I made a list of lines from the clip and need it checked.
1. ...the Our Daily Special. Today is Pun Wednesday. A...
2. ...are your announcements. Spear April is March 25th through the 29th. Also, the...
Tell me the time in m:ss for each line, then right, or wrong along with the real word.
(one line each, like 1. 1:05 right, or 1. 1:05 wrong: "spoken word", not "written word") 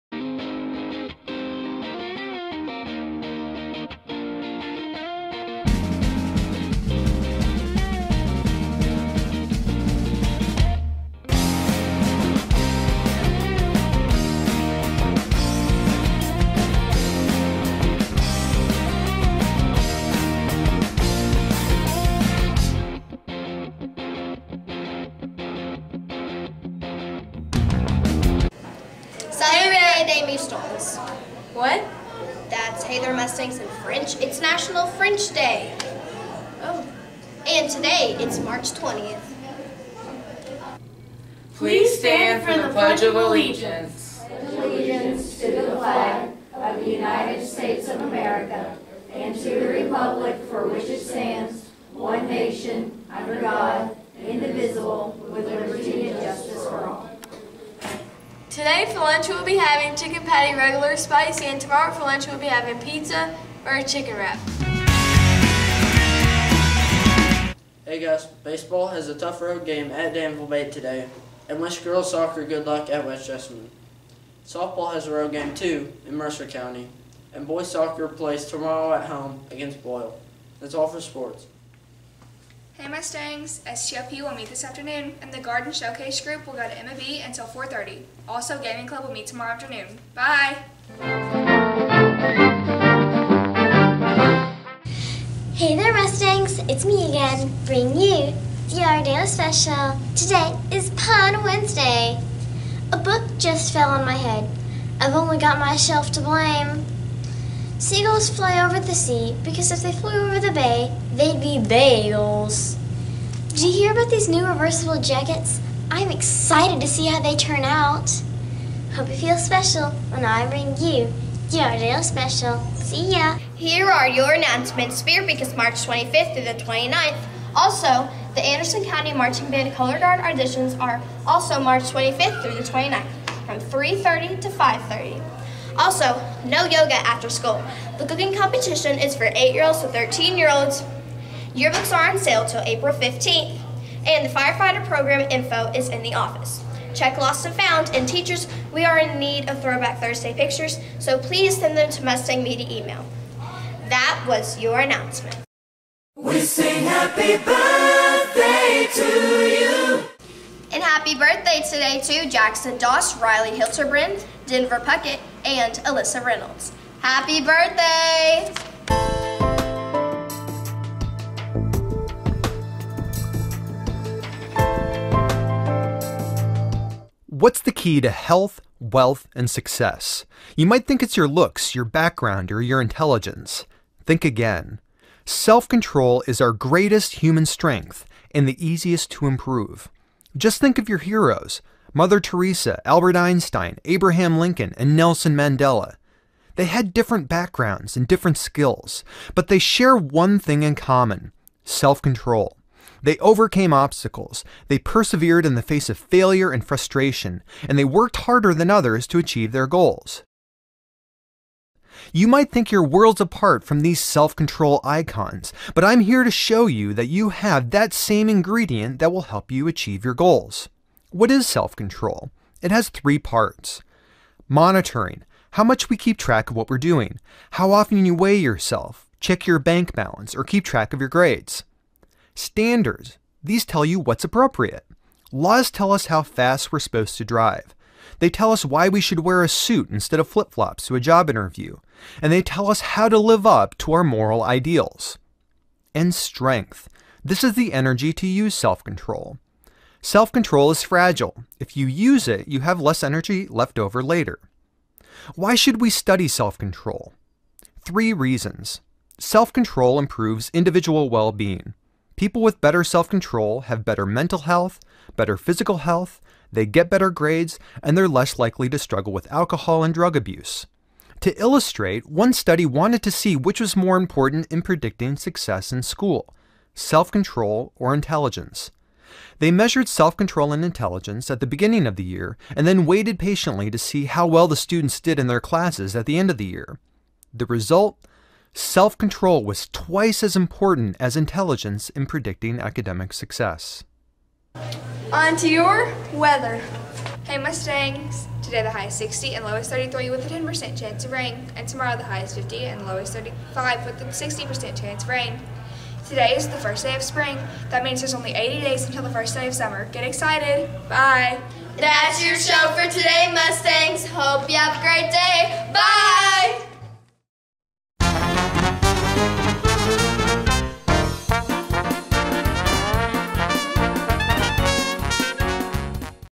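1. 1:38 right
2. 2:03 wrong: "Week", not "April".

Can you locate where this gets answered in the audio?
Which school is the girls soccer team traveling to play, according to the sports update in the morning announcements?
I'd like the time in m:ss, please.
1:13.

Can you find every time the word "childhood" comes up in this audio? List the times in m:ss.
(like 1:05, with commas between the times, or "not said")
not said.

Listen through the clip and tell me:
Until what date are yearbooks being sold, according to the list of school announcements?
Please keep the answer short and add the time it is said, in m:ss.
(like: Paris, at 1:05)
April 15th, at 2:22.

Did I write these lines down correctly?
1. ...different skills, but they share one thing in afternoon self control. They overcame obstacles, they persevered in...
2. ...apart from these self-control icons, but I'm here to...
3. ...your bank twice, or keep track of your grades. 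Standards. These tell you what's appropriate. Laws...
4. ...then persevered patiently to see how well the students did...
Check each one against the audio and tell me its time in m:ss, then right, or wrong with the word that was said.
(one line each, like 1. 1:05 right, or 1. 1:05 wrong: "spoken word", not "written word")
1. 3:18 wrong: "common", not "afternoon"
2. 3:33 right
3. 3:49 wrong: "balance", not "twice"
4. 4:42 wrong: "waited", not "persevered".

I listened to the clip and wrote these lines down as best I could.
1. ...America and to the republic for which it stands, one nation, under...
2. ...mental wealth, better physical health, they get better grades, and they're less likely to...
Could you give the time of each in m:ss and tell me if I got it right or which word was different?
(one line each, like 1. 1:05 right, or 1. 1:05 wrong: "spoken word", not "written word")
1. 0:48 right
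2. 4:24 wrong: "health", not "wealth".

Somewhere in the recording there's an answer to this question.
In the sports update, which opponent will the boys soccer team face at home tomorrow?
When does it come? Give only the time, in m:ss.
1:19.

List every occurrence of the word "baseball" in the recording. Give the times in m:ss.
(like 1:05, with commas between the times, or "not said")
1:08.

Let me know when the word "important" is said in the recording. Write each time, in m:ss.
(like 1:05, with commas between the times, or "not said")
4:33, 4:50.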